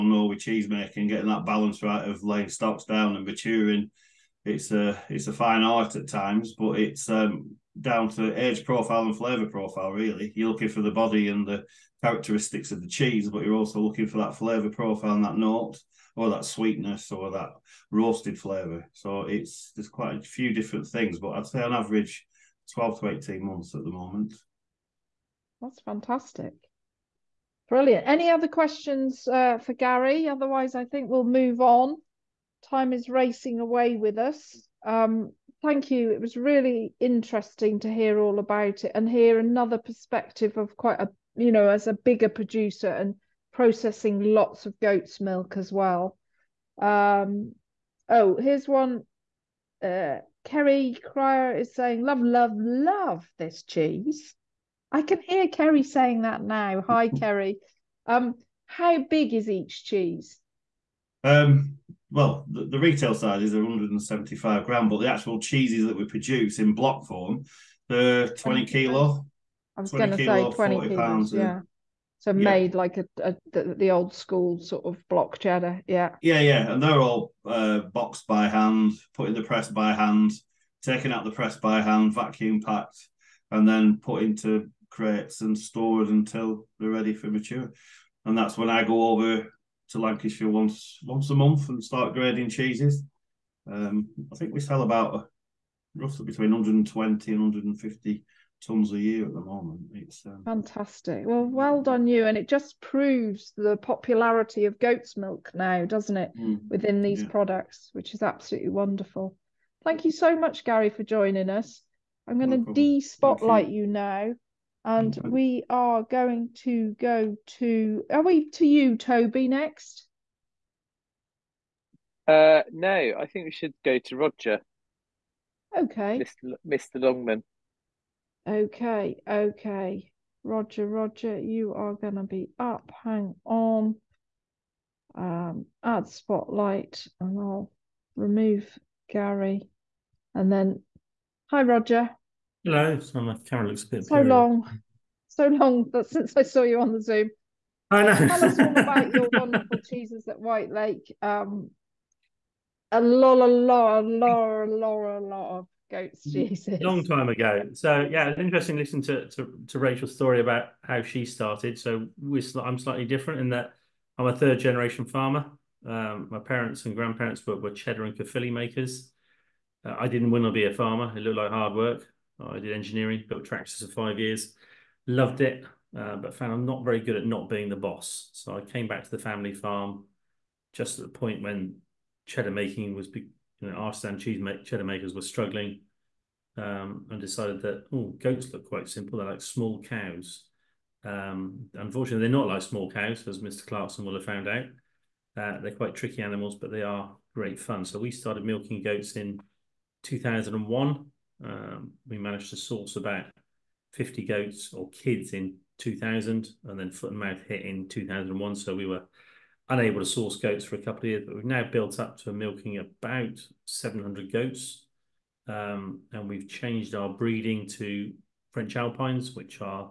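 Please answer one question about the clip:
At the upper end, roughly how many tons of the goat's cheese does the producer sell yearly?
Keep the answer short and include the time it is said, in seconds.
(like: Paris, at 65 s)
150 tons, at 97 s.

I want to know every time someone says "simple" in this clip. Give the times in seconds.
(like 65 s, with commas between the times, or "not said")
188 s.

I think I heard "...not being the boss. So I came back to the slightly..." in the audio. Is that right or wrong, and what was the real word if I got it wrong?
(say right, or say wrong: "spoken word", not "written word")
wrong: "family", not "slightly".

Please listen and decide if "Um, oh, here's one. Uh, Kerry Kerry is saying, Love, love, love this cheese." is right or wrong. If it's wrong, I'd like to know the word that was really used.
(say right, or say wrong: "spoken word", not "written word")
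wrong: "Cryer", not "Kerry".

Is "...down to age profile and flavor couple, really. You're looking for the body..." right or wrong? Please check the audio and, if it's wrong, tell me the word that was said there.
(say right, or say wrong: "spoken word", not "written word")
wrong: "profile", not "couple".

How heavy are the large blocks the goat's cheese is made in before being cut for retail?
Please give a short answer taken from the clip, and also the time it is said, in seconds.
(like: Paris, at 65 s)
20 kilo, at 68 s.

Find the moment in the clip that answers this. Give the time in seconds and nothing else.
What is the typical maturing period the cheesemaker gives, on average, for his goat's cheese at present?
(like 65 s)
22 s.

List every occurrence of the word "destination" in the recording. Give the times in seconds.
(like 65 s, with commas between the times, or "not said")
not said.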